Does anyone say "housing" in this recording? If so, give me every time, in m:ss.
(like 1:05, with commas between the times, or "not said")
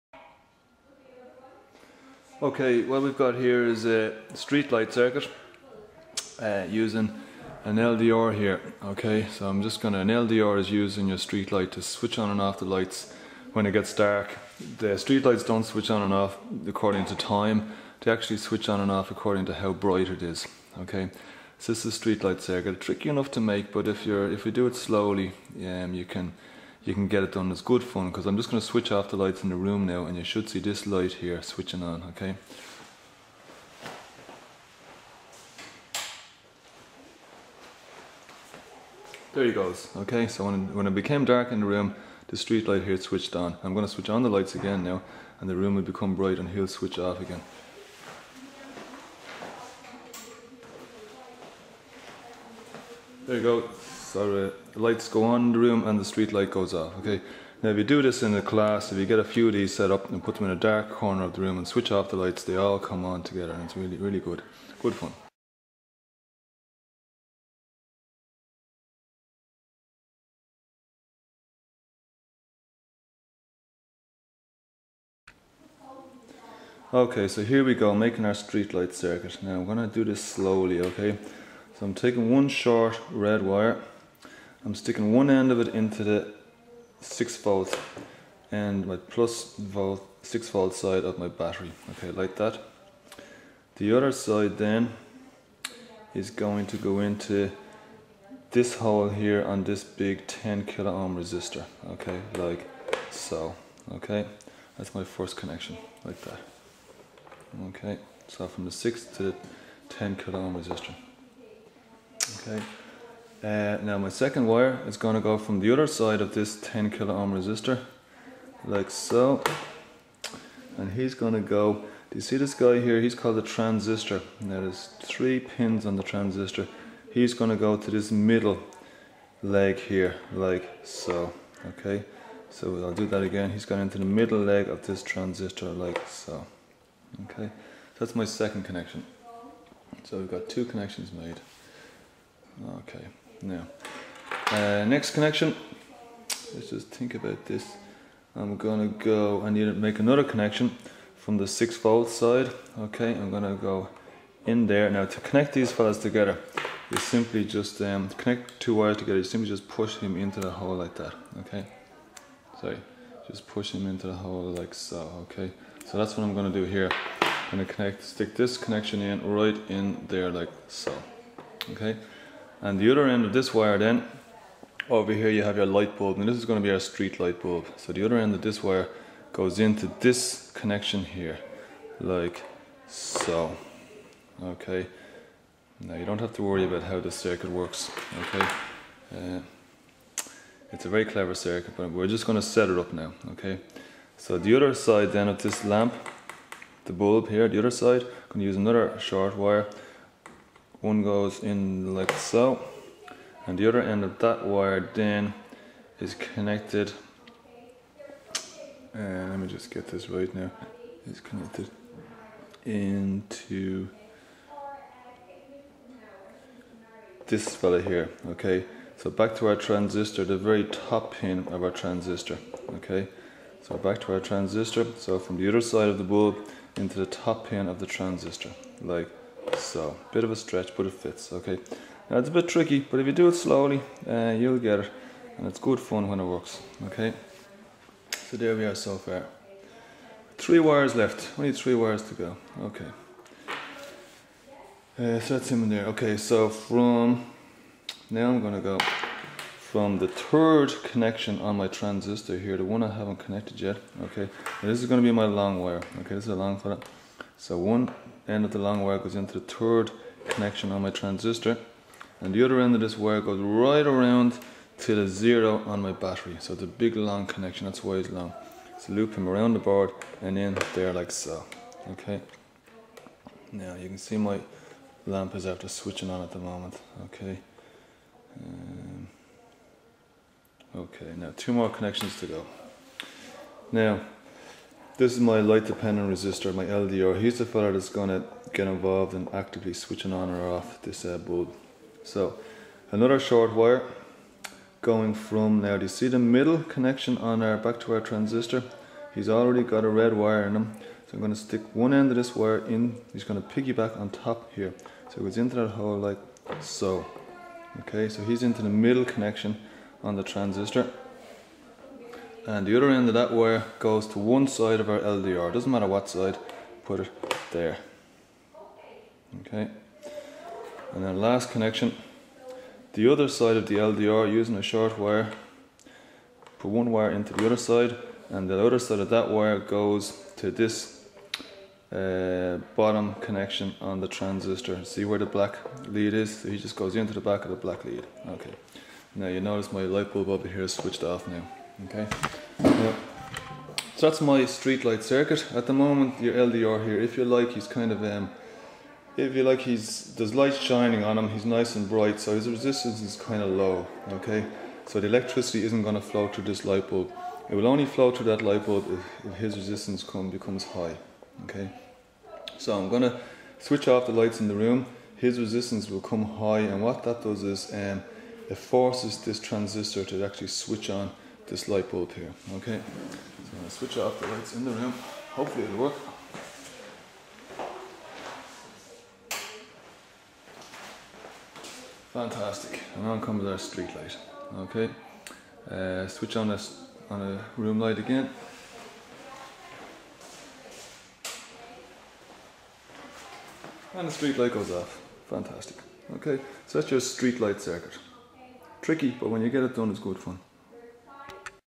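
not said.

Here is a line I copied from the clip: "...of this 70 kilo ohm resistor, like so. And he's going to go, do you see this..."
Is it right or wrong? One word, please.
wrong.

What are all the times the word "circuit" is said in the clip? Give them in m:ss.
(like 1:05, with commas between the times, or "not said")
0:04, 0:22, 1:18, 3:07, 3:11, 5:45, 6:37.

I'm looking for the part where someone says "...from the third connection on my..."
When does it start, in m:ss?
4:09.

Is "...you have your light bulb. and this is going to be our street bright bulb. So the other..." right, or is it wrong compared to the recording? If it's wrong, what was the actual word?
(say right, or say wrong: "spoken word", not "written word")
wrong: "light", not "bright".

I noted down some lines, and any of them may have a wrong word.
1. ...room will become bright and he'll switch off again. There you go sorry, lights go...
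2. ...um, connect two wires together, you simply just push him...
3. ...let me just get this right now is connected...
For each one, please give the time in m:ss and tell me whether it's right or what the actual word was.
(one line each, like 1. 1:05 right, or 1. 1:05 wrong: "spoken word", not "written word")
1. 0:45 right
2. 2:37 right
3. 3:29 right.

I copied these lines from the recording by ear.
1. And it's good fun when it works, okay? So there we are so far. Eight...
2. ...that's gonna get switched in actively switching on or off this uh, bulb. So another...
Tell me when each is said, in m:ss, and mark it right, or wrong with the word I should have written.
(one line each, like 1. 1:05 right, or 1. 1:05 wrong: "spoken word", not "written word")
1. 3:55 wrong: "Three", not "Eight"
2. 4:47 wrong: "involved", not "switched".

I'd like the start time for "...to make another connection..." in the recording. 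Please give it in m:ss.
2:29.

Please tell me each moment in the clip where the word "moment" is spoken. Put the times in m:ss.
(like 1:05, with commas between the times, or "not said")
4:36, 5:45.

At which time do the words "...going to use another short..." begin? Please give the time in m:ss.
3:18.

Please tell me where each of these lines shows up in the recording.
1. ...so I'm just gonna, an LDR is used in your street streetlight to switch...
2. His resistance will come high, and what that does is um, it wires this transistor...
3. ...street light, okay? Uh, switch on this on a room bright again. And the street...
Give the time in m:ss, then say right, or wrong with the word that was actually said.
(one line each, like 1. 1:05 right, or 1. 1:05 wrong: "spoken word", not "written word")
1. 0:09 wrong: "light", not "streetlight"
2. 6:05 wrong: "forces", not "wires"
3. 6:23 wrong: "light", not "bright".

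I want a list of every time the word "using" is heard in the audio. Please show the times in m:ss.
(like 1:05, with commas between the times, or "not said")
0:06, 5:24.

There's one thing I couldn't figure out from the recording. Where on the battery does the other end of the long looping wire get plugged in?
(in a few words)
the zero.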